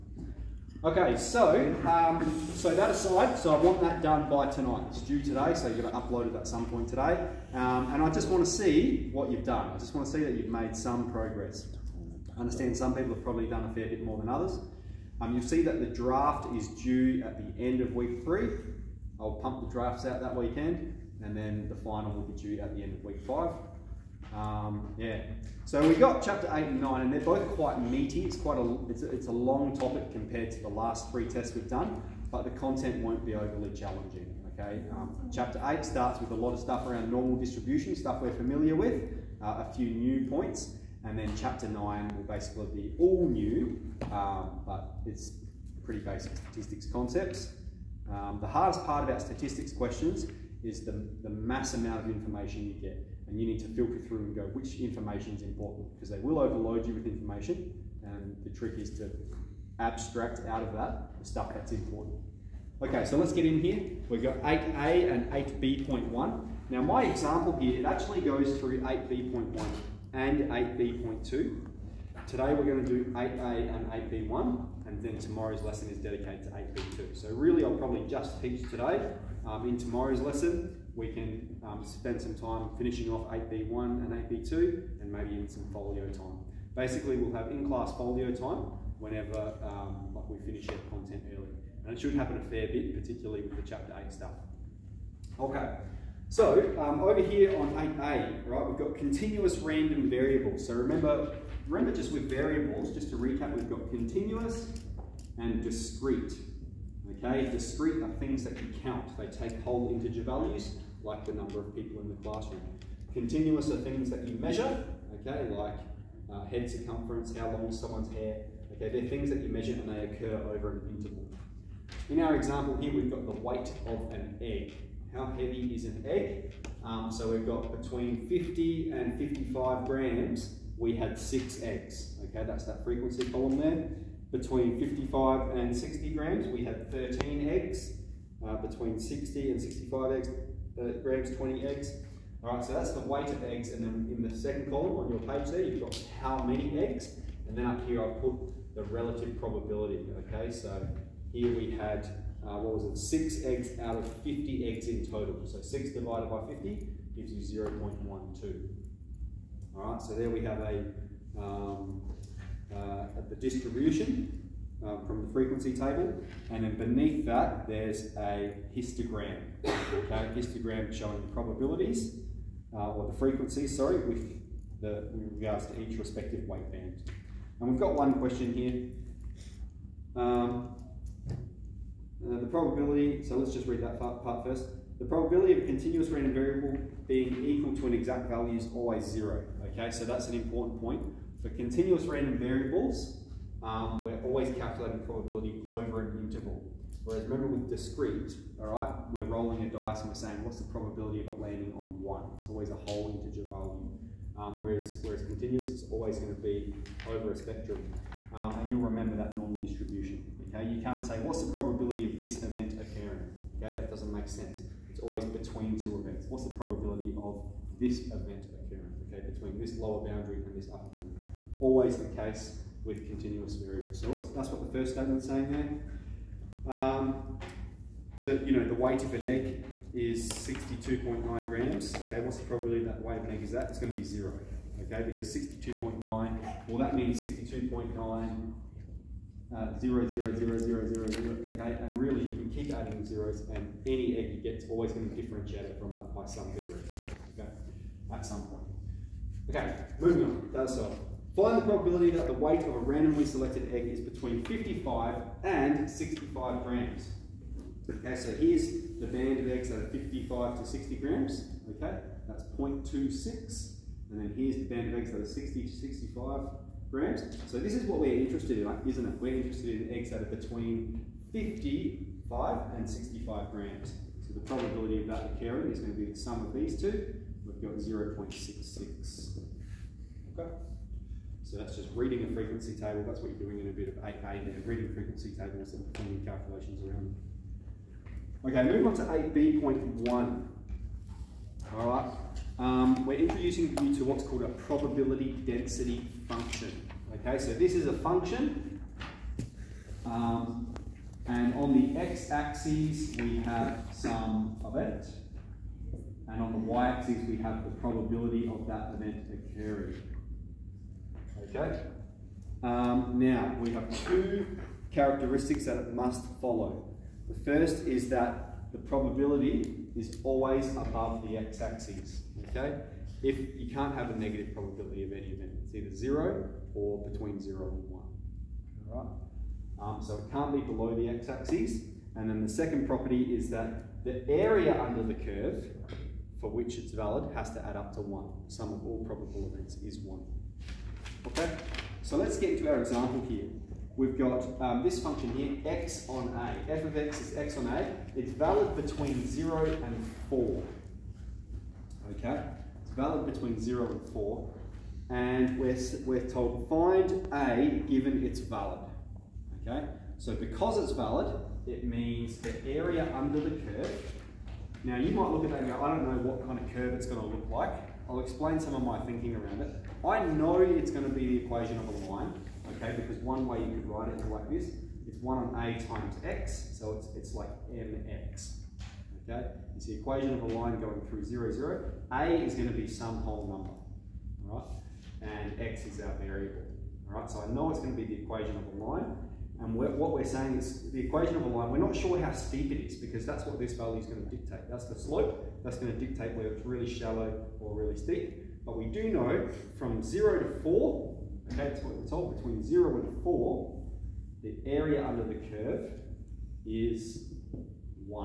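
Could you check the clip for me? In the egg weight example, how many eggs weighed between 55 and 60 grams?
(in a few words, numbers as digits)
13.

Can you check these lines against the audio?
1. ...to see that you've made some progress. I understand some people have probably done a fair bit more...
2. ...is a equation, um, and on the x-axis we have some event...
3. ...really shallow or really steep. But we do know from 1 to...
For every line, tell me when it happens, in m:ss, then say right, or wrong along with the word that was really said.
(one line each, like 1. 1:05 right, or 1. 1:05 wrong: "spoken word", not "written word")
1. 0:10 right
2. 4:57 wrong: "function", not "equation"
3. 6:36 wrong: "0", not "1".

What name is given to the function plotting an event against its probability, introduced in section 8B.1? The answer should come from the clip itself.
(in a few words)
Probability density function.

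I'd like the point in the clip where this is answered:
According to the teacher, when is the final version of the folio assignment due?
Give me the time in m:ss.
0:22.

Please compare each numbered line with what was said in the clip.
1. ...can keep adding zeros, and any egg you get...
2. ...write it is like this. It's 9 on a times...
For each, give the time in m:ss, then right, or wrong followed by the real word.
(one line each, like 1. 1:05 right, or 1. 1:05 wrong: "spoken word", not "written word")
1. 4:02 right
2. 6:13 wrong: "1", not "9".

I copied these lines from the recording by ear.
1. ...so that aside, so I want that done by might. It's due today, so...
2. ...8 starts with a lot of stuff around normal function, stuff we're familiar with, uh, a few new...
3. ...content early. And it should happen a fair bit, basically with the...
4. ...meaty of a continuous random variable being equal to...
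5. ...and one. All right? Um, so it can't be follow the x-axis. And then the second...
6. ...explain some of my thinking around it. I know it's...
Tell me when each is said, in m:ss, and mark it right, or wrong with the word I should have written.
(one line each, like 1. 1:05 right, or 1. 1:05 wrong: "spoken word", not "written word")
1. 0:02 wrong: "tonight", not "might"
2. 0:35 wrong: "distribution", not "function"
3. 1:30 wrong: "particularly", not "basically"
4. 3:05 wrong: "probability", not "meaty"
5. 5:27 wrong: "below", not "follow"
6. 6:08 right.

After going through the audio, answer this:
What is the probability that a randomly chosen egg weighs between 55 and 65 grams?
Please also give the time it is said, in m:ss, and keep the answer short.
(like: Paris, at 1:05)
0.66, at 4:37.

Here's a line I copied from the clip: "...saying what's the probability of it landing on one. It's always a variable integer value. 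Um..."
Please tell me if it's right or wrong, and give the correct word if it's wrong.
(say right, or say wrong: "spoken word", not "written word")
wrong: "whole", not "variable".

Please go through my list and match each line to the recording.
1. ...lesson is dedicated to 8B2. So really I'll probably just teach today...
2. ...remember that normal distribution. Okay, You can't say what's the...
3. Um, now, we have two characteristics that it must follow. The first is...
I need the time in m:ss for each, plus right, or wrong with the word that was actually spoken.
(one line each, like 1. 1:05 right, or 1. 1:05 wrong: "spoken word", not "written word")
1. 1:15 right
2. 3:28 right
3. 5:12 right.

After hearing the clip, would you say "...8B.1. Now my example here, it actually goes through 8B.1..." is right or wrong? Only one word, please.
right.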